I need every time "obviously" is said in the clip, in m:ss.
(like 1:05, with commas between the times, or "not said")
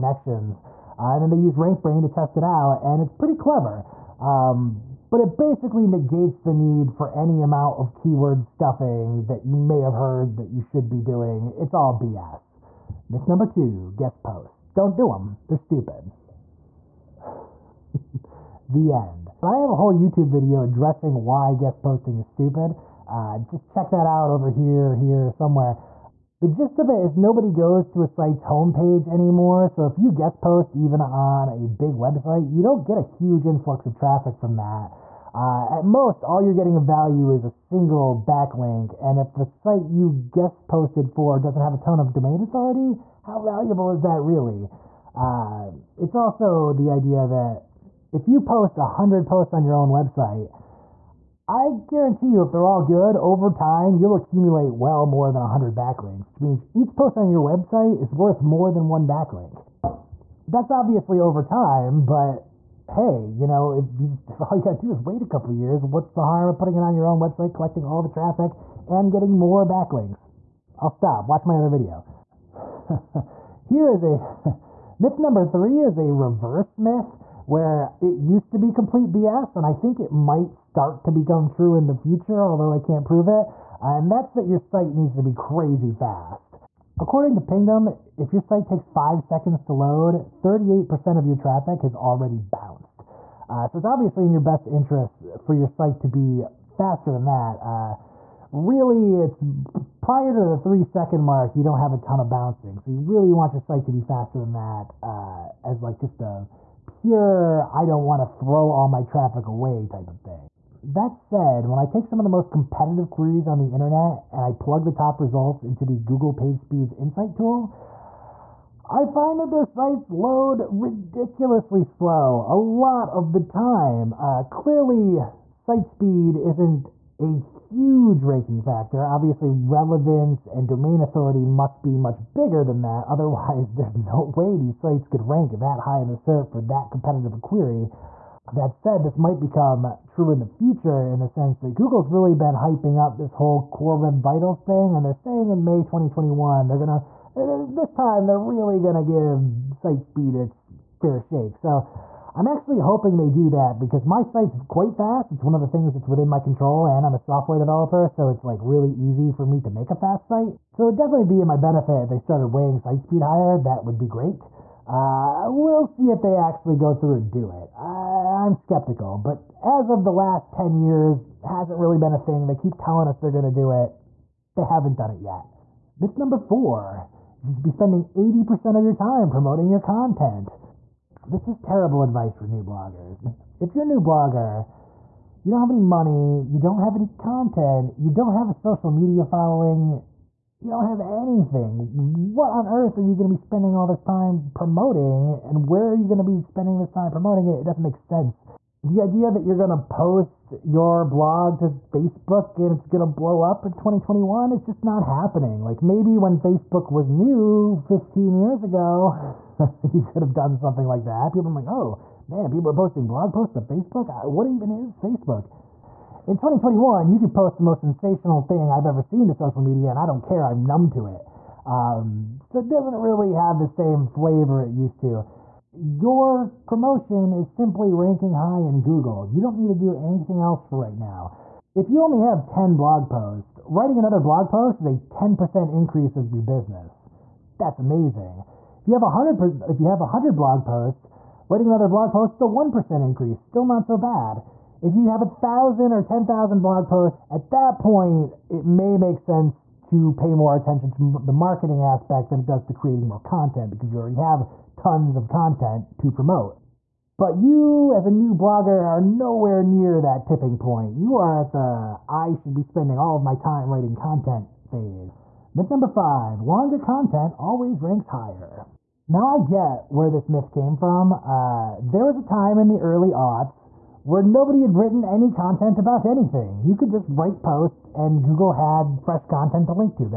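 1:00, 1:33, 2:09.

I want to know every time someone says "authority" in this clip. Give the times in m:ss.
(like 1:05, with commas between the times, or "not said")
0:42, 2:10.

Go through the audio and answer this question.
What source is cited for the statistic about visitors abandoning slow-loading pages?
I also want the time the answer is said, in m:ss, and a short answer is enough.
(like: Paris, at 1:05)
Pingdom, at 1:27.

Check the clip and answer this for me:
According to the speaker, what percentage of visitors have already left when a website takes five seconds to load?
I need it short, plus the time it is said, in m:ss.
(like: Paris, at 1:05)
38%, at 1:30.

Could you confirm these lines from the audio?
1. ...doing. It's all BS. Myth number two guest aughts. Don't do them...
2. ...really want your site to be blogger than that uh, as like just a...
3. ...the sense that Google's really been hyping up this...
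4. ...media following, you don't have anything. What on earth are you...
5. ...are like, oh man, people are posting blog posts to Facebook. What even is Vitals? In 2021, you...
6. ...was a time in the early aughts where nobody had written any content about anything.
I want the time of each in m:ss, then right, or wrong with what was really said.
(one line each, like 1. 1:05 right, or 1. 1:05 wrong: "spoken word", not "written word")
1. 0:10 wrong: "posts", not "aughts"
2. 1:43 wrong: "faster", not "blogger"
3. 2:21 right
4. 3:08 right
5. 3:31 wrong: "Facebook", not "Vitals"
6. 4:32 right.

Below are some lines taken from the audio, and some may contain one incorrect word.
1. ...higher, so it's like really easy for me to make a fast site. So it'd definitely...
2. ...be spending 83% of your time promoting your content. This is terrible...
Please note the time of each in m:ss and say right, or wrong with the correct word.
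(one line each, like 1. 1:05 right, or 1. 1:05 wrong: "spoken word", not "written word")
1. 2:37 wrong: "developer", not "higher"
2. 2:57 wrong: "80", not "83".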